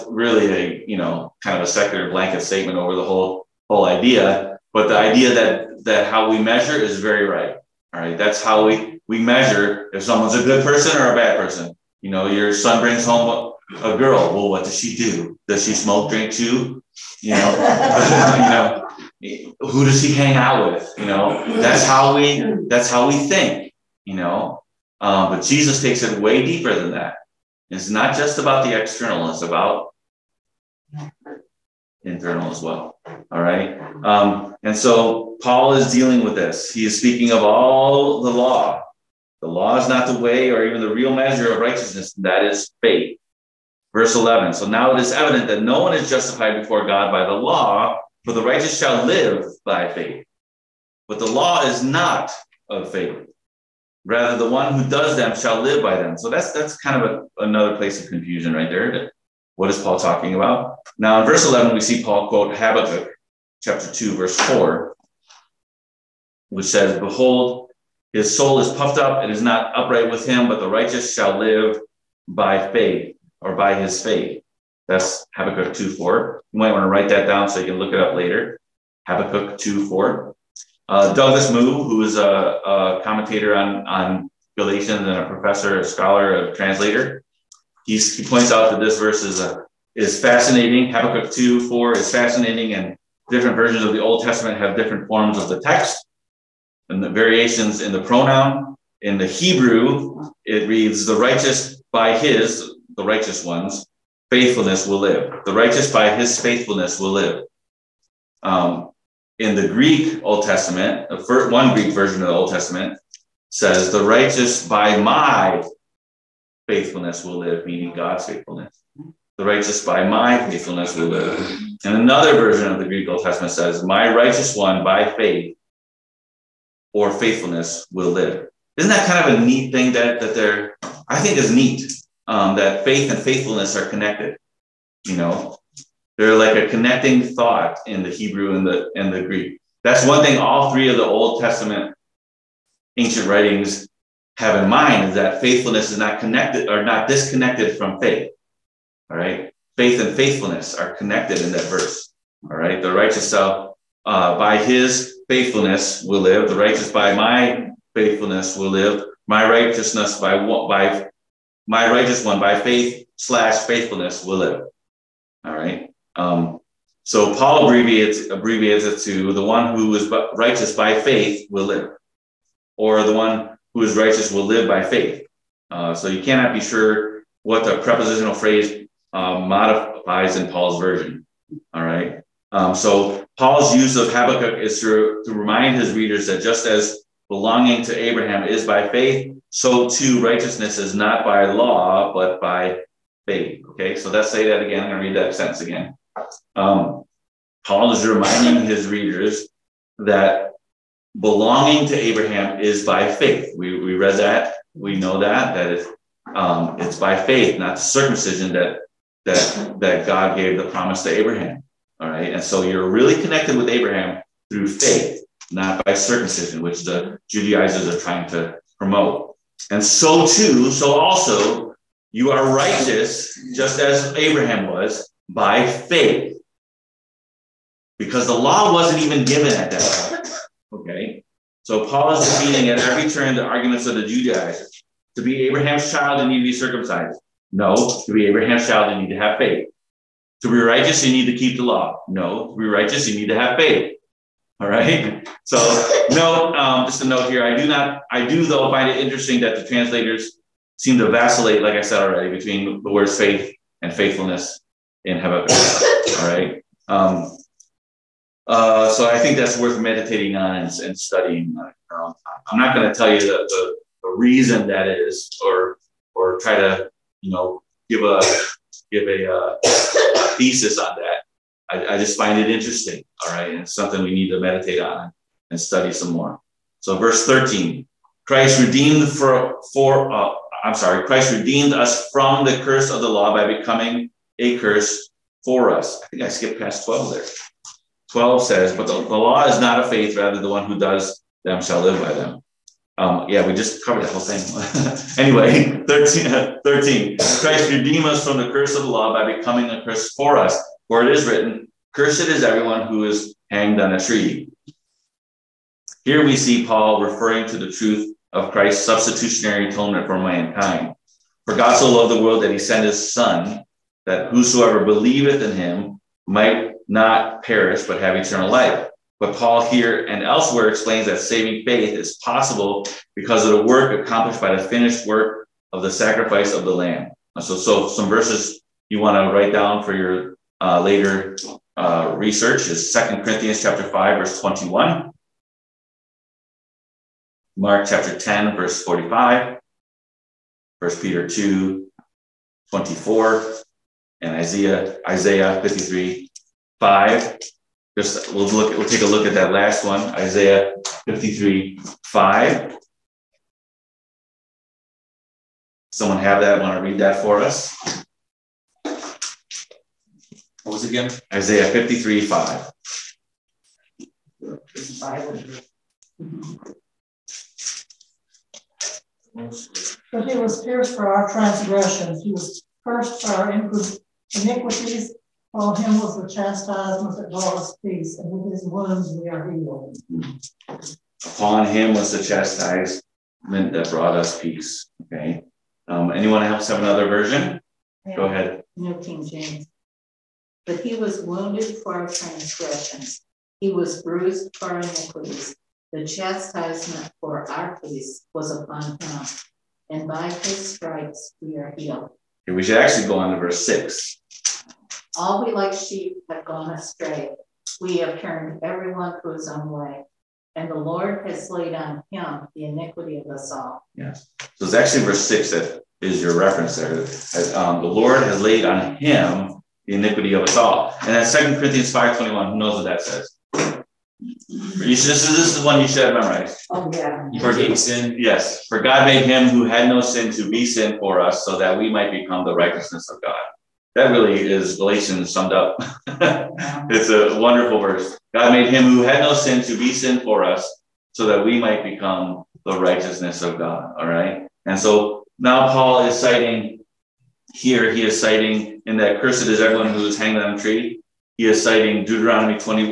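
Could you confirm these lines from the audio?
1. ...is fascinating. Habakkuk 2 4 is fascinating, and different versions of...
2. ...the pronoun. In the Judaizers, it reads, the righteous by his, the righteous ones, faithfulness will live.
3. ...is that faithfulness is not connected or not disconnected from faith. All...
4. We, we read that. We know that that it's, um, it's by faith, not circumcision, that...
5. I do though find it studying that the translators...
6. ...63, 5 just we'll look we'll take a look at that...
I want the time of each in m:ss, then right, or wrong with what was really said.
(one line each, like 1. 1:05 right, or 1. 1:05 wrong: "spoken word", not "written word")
1. 1:29 right
2. 1:37 wrong: "Hebrew", not "Judaizers"
3. 2:25 right
4. 3:23 right
5. 4:08 wrong: "interesting", not "studying"
6. 5:45 wrong: "53", not "63".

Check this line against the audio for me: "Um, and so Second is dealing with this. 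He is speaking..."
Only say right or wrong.
wrong.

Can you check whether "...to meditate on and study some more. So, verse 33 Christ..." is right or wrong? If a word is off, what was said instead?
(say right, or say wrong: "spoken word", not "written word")
wrong: "13", not "33".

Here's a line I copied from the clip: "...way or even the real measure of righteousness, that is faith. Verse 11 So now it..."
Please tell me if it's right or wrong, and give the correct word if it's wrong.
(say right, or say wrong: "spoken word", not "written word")
right.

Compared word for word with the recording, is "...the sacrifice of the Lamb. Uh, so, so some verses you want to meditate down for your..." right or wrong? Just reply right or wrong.
wrong.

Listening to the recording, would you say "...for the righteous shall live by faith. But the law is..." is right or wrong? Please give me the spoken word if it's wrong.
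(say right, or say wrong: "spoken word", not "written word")
right.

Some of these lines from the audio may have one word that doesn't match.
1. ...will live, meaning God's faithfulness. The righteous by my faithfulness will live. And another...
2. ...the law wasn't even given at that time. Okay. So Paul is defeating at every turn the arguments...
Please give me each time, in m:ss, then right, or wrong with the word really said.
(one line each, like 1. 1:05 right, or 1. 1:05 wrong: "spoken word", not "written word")
1. 1:57 right
2. 3:48 right.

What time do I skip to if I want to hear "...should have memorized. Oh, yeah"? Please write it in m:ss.
7:05.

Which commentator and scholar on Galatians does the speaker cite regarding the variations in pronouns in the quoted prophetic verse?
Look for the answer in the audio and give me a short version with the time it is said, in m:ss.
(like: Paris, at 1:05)
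Douglas Moo, at 1:21.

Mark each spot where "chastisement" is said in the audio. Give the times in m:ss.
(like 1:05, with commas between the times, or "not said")
6:16, 6:22, 6:36.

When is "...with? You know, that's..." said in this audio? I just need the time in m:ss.
0:20.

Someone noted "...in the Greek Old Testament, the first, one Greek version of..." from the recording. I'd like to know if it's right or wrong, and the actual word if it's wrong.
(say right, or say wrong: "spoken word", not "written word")
right.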